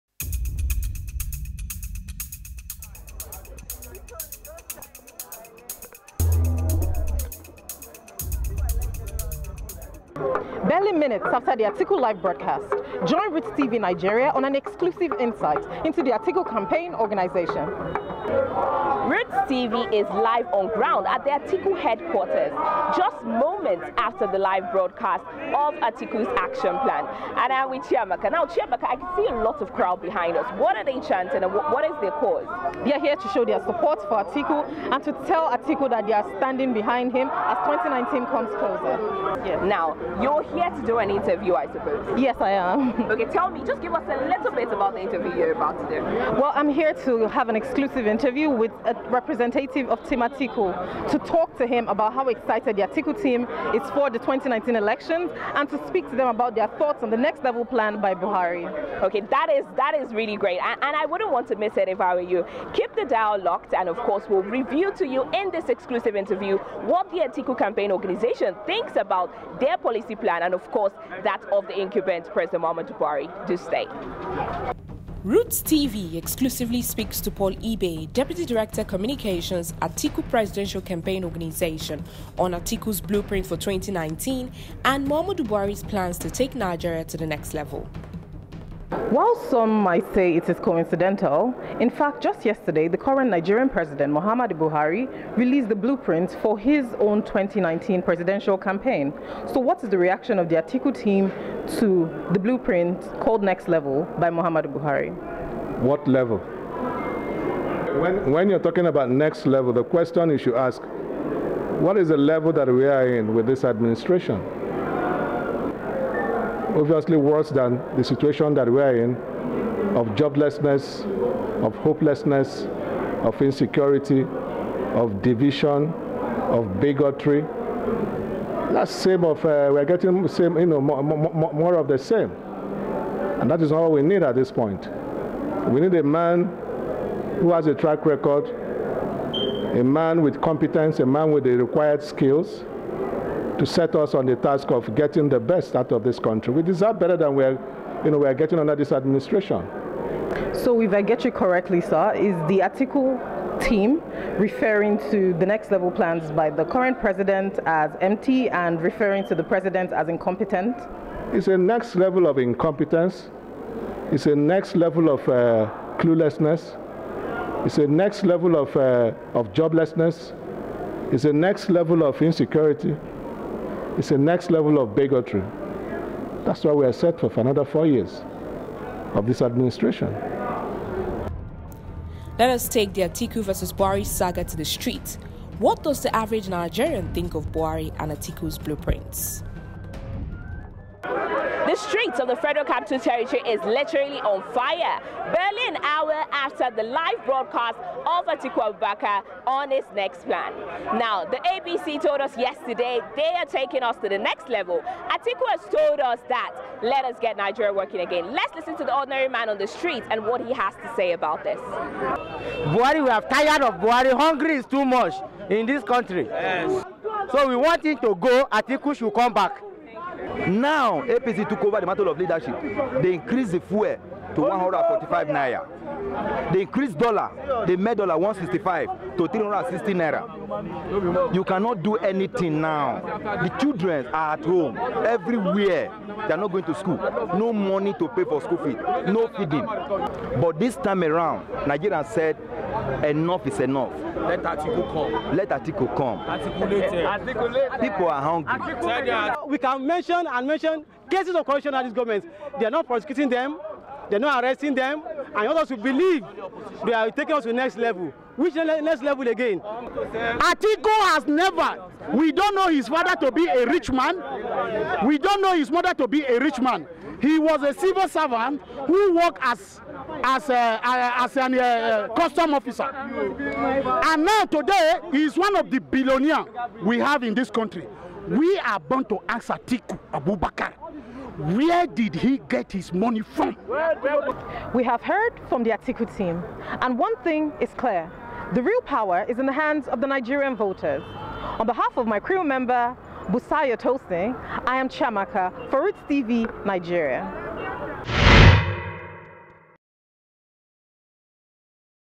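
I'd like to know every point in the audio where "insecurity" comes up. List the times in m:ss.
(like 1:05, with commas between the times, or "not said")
2:03, 2:52.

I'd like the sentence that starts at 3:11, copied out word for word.
The streets of the Federal Capital Territory is literally on fire.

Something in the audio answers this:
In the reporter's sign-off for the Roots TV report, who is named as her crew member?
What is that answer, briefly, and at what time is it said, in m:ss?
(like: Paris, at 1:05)
Busaya Tosin, at 4:53.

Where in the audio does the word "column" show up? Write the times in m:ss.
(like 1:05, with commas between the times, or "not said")
not said.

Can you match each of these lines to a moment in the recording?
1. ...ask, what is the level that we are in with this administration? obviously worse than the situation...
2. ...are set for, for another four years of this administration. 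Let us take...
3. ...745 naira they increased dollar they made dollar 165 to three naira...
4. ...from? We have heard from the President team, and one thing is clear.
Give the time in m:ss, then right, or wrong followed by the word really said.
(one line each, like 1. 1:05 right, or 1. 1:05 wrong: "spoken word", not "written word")
1. 1:50 right
2. 2:56 right
3. 3:44 wrong: "145", not "745"
4. 4:43 wrong: "Atiku", not "President".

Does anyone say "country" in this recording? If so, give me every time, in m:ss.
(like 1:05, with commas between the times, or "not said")
2:26, 3:35, 4:37.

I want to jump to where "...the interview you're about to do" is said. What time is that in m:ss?
0:44.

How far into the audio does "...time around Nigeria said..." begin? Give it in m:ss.
4:00.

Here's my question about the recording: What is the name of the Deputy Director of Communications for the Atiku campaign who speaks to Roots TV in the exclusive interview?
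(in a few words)
Paul Ibe.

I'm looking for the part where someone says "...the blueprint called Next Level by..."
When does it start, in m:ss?
1:42.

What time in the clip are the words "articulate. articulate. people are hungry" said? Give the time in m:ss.
4:06.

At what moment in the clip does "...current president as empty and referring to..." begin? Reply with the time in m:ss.
2:36.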